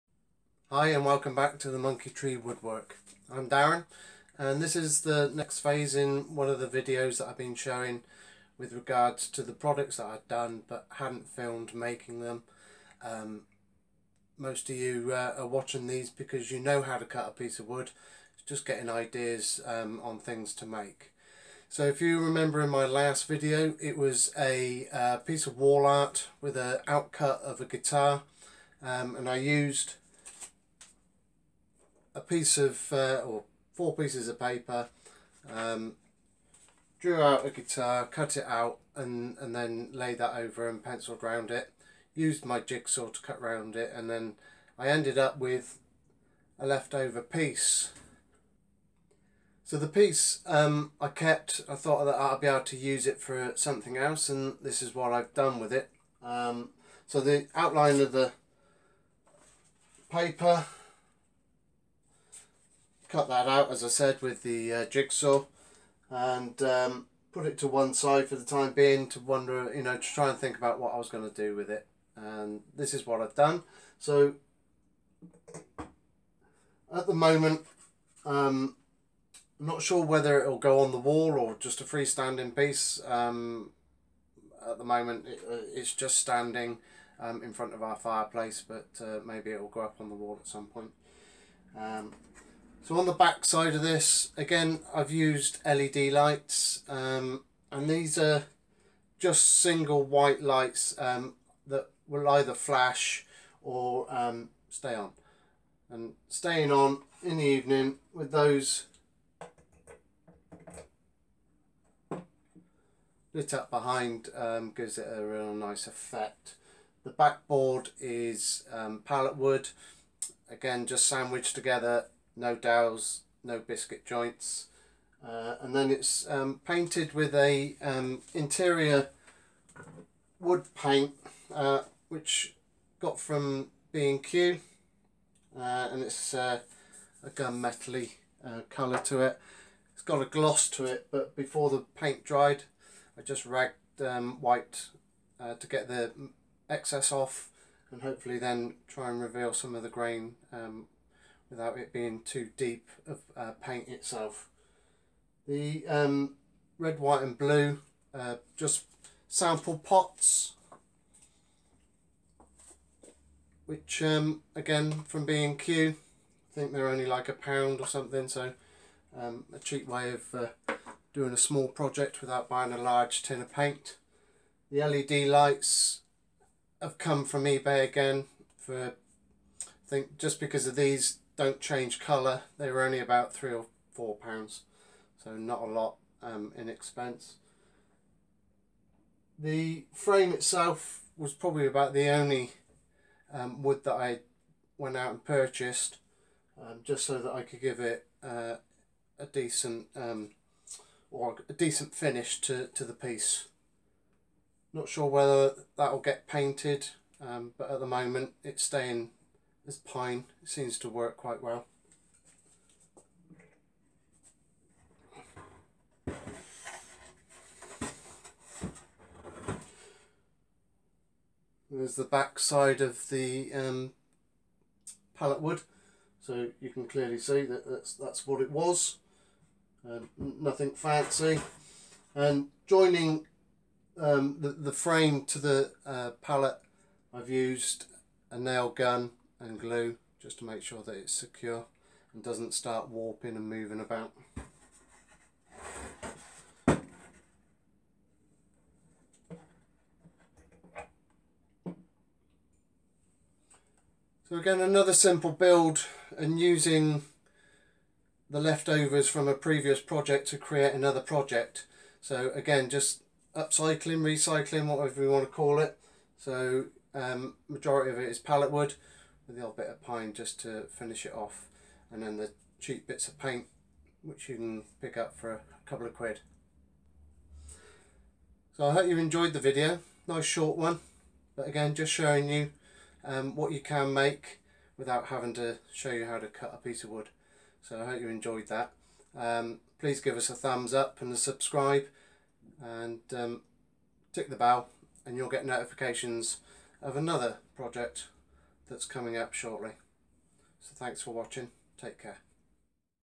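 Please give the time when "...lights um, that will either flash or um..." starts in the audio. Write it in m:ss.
1:40.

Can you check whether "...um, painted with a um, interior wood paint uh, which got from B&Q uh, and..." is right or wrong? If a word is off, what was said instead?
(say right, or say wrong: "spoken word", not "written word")
right.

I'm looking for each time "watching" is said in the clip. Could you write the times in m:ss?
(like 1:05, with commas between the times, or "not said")
0:15, 5:01.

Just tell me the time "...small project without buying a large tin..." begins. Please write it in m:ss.
2:51.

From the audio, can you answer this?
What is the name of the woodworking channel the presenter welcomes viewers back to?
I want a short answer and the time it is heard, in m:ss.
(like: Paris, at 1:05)
Monkey Tree Woodwork, at 0:01.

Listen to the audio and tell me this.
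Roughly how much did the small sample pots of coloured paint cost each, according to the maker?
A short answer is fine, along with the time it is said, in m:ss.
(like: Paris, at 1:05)
a pound, at 2:47.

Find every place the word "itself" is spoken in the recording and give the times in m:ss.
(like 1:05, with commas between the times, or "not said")
2:33, 3:10.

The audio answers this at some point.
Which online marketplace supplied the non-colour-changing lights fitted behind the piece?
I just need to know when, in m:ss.
2:57.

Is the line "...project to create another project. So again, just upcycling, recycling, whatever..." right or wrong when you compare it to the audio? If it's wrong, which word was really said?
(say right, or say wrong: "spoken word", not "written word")
right.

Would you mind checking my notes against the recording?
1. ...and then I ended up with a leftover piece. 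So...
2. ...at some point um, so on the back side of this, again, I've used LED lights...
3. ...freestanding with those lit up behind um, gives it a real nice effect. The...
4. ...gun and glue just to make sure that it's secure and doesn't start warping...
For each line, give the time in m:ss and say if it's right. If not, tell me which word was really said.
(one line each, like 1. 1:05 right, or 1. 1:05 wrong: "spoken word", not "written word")
1. 0:43 right
2. 1:30 right
3. 1:47 wrong: "evening", not "freestanding"
4. 3:58 right.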